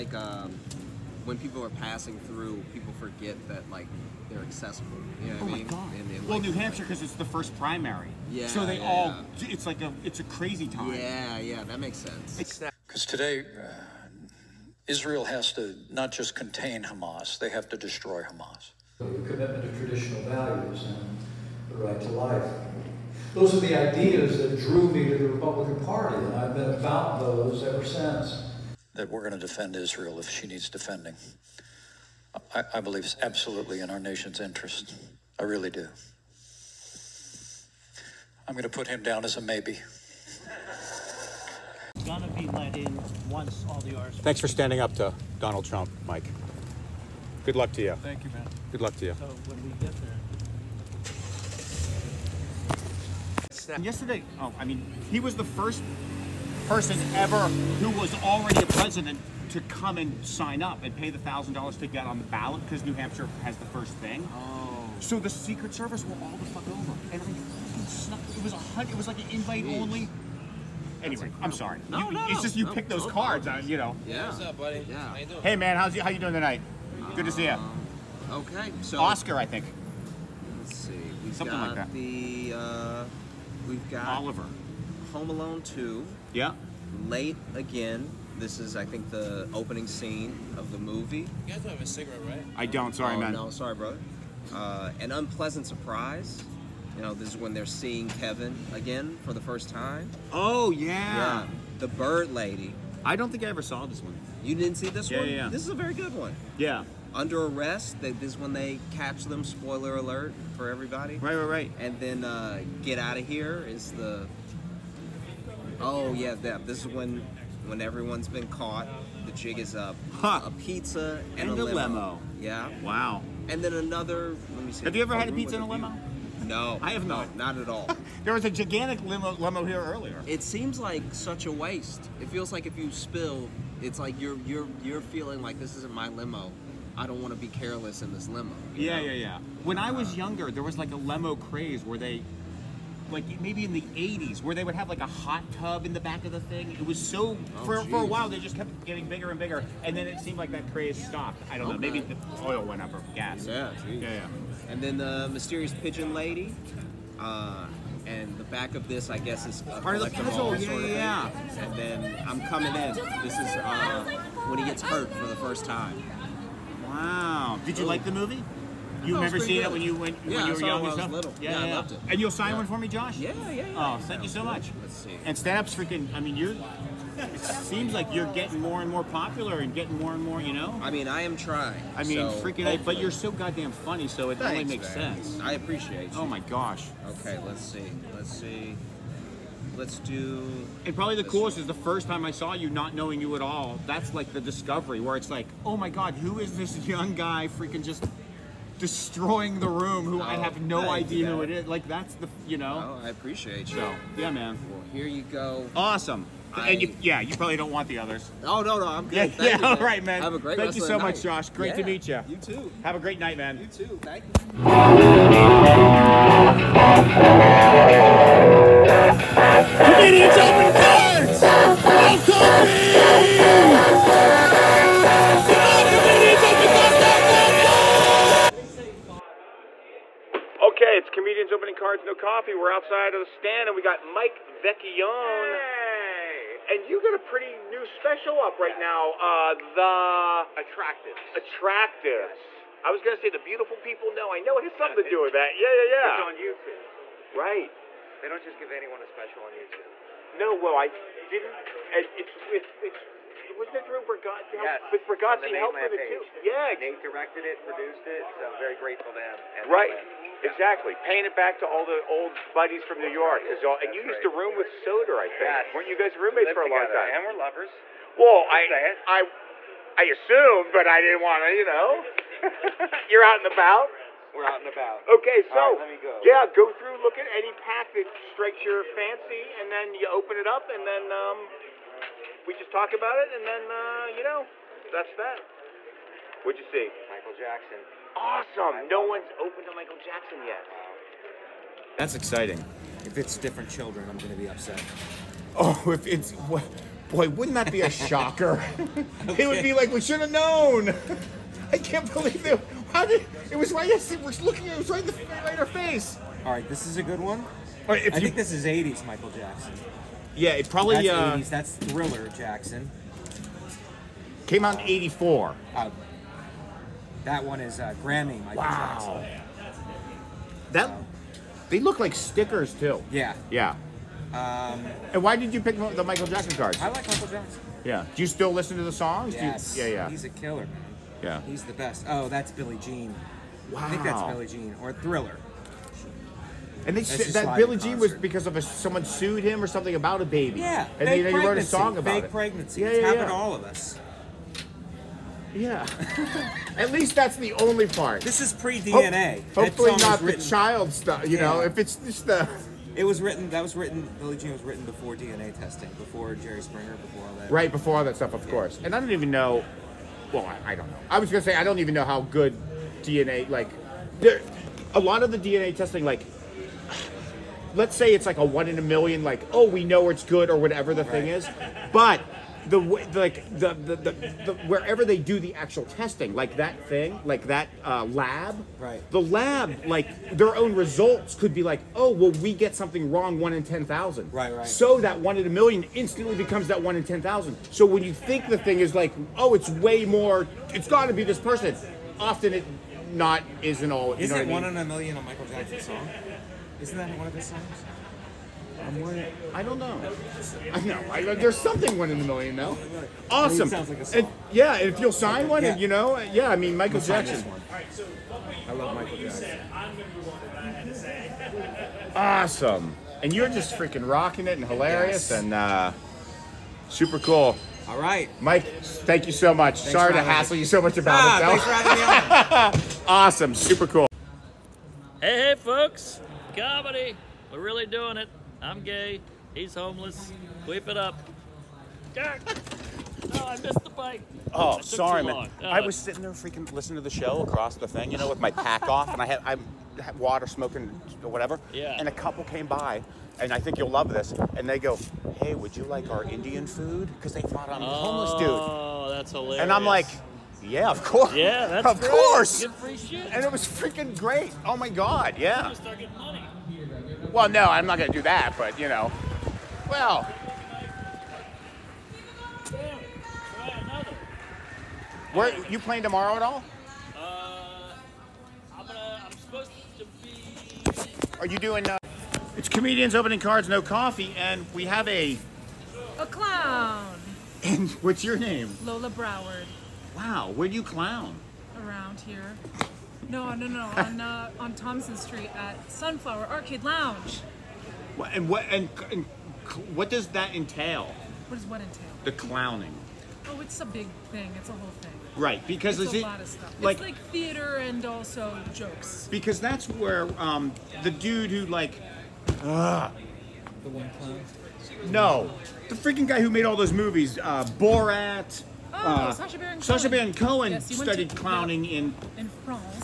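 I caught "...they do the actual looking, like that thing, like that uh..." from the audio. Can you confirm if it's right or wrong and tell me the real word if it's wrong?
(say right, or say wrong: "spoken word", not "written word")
wrong: "testing", not "looking".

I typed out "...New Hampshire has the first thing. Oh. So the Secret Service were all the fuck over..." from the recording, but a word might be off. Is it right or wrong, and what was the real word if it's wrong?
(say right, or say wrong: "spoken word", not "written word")
right.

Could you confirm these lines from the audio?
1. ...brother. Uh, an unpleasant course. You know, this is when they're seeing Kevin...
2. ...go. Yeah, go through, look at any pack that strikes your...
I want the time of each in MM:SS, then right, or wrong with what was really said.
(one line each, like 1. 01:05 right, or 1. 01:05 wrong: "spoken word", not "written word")
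1. 01:33 wrong: "surprise", not "course"
2. 04:36 right.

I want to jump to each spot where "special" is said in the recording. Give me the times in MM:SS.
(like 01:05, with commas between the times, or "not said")
03:57, 04:09.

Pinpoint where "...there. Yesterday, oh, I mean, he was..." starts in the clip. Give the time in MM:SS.
00:53.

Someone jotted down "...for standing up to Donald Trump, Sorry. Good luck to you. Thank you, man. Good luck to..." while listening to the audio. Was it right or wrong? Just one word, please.
wrong.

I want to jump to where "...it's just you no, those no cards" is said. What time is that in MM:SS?
01:12.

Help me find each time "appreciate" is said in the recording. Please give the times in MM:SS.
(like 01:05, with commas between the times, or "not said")
03:05, 03:23.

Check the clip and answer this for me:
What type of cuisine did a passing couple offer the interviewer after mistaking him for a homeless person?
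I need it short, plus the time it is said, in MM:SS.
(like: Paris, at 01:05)
Indian food, at 07:26.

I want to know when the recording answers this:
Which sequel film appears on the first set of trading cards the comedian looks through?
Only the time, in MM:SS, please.
01:25.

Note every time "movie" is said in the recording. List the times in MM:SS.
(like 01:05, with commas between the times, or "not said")
01:30, 02:48, 08:26.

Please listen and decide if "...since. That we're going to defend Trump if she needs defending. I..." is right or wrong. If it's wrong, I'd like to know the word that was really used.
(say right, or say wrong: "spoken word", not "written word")
wrong: "Israel", not "Trump".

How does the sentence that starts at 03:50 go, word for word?
Okay, it's comedians opening cards, no coffee.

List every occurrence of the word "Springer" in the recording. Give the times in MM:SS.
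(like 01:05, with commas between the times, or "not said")
05:56.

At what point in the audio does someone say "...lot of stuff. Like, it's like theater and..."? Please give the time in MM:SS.
08:16.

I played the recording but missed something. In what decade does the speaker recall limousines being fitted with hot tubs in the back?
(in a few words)
the 80s.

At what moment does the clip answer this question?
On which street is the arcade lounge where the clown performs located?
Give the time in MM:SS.
08:04.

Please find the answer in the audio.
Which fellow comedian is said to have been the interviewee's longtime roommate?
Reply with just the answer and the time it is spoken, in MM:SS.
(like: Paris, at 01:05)
Soder, at 04:24.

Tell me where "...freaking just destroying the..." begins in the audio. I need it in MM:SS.
03:17.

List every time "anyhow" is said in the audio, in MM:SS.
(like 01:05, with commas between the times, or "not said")
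not said.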